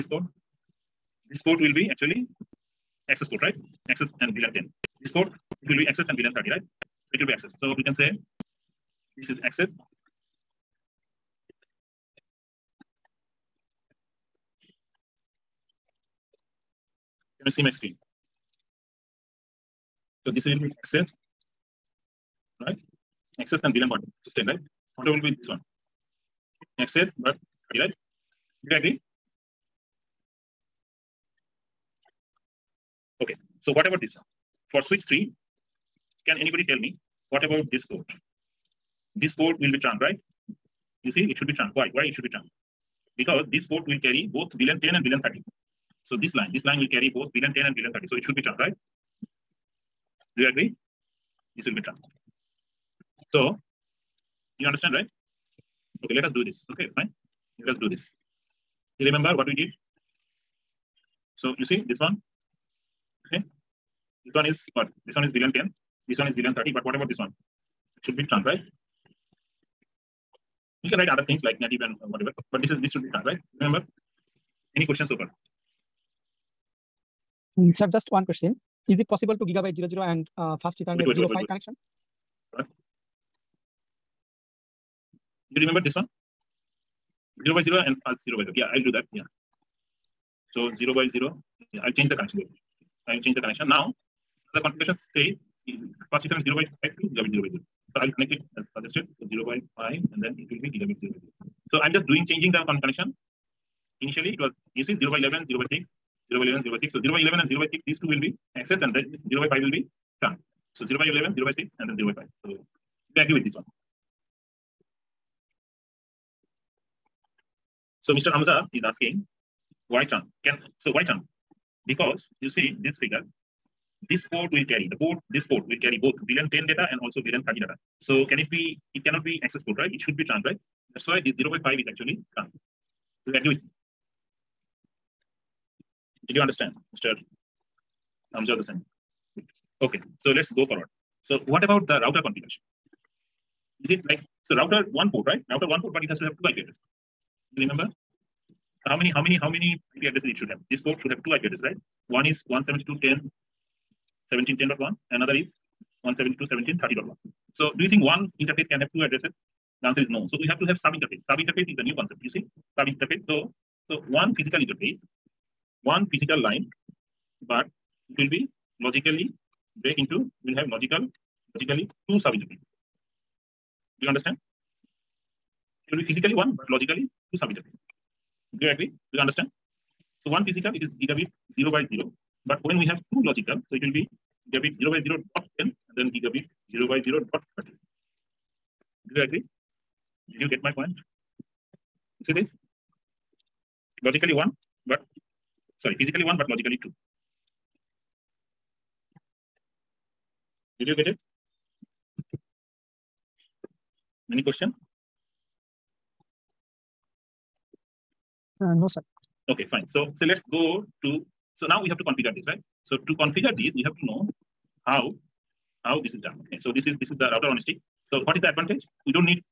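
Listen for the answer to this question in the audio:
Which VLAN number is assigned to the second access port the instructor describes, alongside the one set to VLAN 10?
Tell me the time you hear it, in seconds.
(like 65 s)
5 s.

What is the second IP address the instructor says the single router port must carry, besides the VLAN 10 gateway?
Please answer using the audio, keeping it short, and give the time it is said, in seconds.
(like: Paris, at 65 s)
172.17.30.1, at 156 s.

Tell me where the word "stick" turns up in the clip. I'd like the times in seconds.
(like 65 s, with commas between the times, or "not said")
217 s.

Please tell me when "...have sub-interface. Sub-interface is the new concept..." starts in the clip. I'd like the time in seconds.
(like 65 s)
160 s.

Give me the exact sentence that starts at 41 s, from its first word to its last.
You see, it should be trunk.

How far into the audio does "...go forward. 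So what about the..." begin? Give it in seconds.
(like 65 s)
140 s.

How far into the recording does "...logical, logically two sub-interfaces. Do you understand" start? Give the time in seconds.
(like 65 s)
170 s.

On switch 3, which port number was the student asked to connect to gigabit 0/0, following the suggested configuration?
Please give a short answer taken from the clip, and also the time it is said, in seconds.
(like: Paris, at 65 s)
0/5, at 96 s.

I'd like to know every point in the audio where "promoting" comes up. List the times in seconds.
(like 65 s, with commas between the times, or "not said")
not said.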